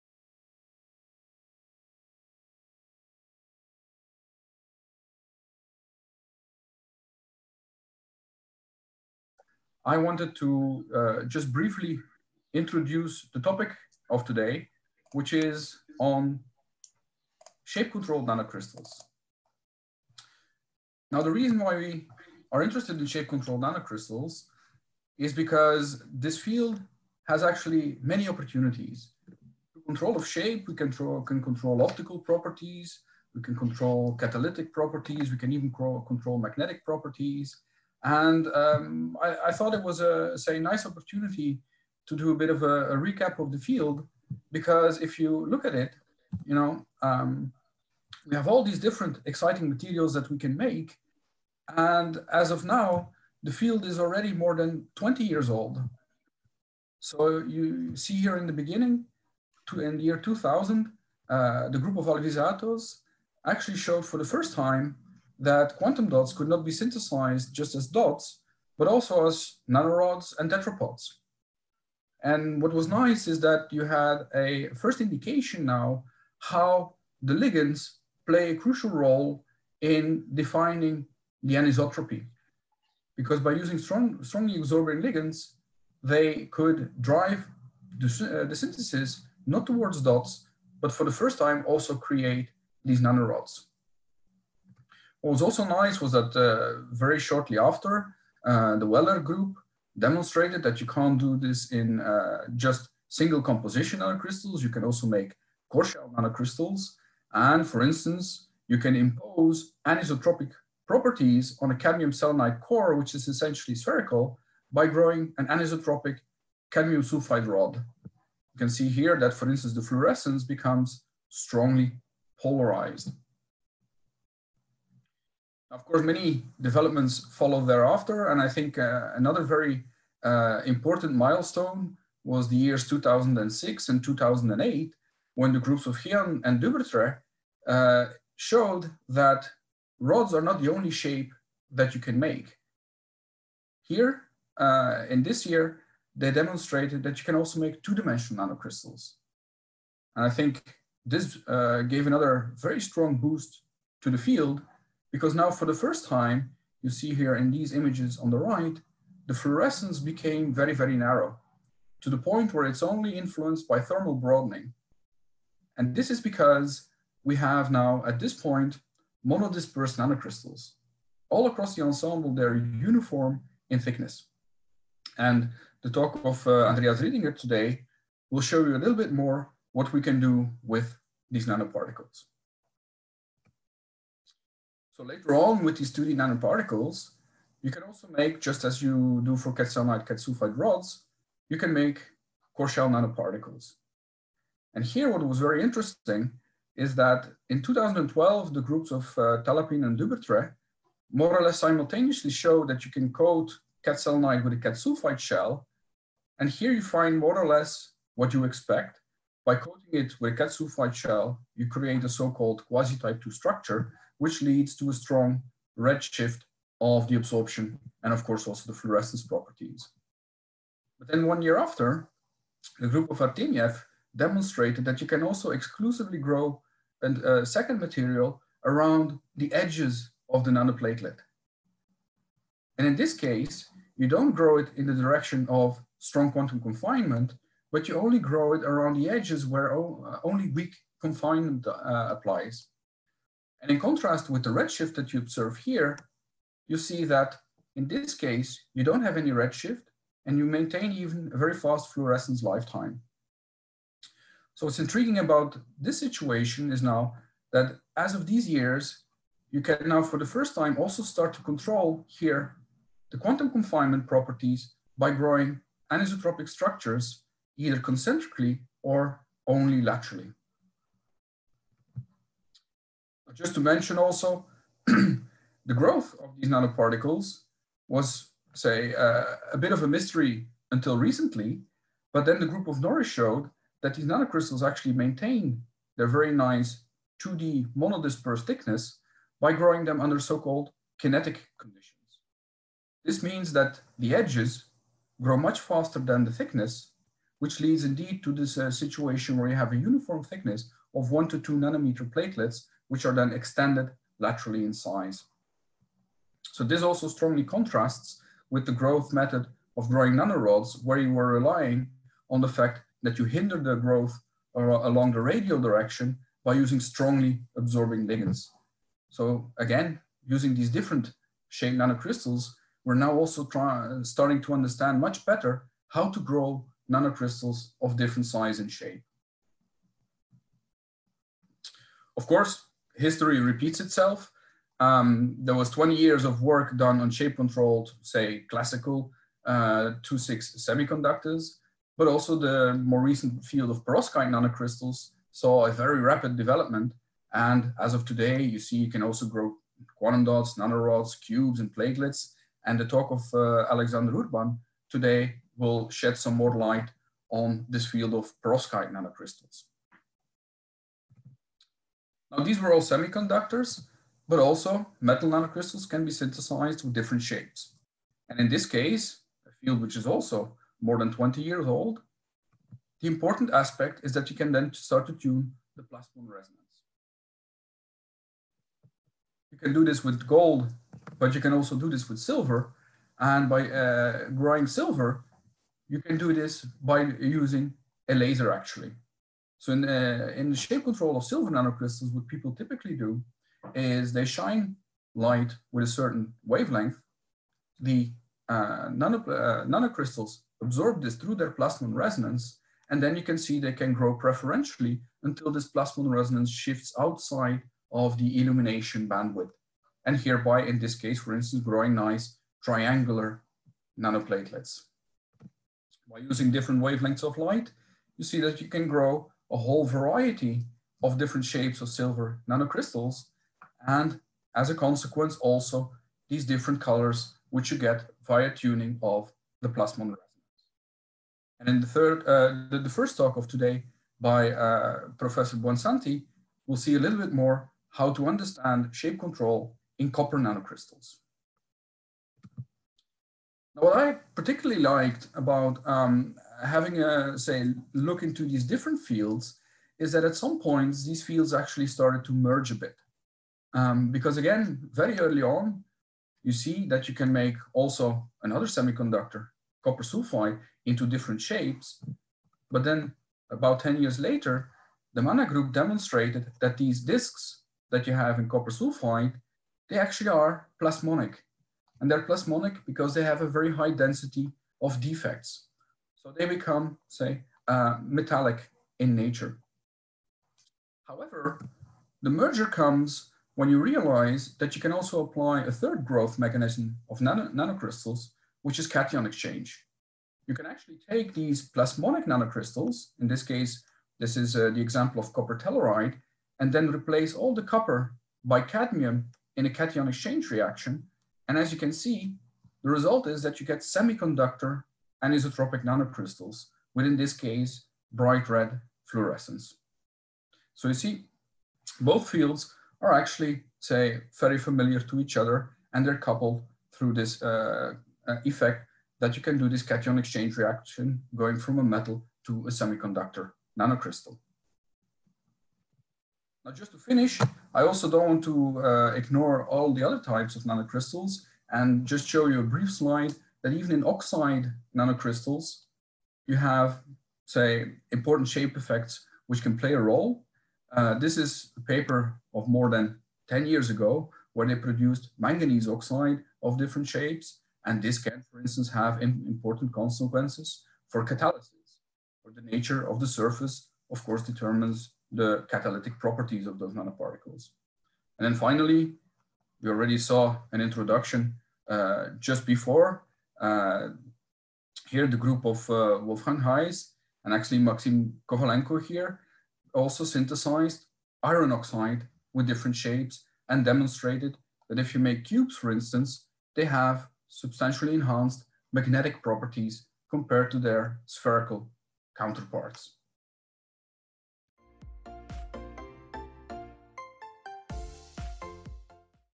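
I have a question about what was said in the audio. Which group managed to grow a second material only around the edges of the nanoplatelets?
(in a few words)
Artemyev.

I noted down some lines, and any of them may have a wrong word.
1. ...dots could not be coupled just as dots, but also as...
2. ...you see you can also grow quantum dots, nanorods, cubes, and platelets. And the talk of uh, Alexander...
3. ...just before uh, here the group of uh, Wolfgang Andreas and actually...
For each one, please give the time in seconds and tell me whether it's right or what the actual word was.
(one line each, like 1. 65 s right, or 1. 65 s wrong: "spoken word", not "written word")
1. 66 s wrong: "synthesized", not "coupled"
2. 348 s right
3. 562 s wrong: "Heiss", not "Andreas".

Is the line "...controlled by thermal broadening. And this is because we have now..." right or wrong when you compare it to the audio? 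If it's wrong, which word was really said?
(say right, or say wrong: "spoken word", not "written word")
wrong: "influenced", not "controlled".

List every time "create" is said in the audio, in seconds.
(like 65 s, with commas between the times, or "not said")
91 s, 211 s.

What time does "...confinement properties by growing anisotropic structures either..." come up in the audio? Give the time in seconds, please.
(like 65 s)
263 s.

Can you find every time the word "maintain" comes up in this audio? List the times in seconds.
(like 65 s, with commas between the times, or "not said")
250 s, 284 s.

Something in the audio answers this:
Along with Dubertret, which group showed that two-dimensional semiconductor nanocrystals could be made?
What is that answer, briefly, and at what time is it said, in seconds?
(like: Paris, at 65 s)
Hyeon, at 135 s.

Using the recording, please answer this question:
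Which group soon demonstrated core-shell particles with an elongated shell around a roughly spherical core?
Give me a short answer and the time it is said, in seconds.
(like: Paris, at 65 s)
Weller, at 98 s.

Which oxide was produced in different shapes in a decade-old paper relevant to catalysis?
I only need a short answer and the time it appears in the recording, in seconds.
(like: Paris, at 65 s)
Manganese oxide, at 545 s.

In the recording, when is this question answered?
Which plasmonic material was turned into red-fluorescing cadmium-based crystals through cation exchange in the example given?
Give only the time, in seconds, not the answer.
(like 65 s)
495 s.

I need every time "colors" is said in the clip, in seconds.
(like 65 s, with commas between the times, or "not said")
426 s.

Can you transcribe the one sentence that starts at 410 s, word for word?
And hereby, in this case, for instance, growing nice triangular nanoplatelets.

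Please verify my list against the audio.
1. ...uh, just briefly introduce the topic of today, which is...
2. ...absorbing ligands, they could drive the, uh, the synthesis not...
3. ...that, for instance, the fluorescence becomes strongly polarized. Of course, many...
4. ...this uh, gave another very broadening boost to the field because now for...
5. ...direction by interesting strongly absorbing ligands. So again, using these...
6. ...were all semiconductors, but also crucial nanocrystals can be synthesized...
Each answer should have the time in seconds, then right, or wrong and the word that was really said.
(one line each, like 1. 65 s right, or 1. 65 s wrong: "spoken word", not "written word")
1. 10 s right
2. 84 s right
3. 119 s right
4. 151 s wrong: "strong", not "broadening"
5. 315 s wrong: "using", not "interesting"
6. 362 s wrong: "metal", not "crucial".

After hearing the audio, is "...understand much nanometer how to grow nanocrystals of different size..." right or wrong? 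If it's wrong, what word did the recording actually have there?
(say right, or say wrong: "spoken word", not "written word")
wrong: "better", not "nanometer".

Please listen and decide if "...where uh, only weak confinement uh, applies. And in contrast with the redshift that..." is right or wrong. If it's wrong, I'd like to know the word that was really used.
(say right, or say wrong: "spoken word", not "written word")
right.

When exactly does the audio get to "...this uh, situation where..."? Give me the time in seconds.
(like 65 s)
298 s.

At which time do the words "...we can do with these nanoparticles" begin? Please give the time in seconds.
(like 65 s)
179 s.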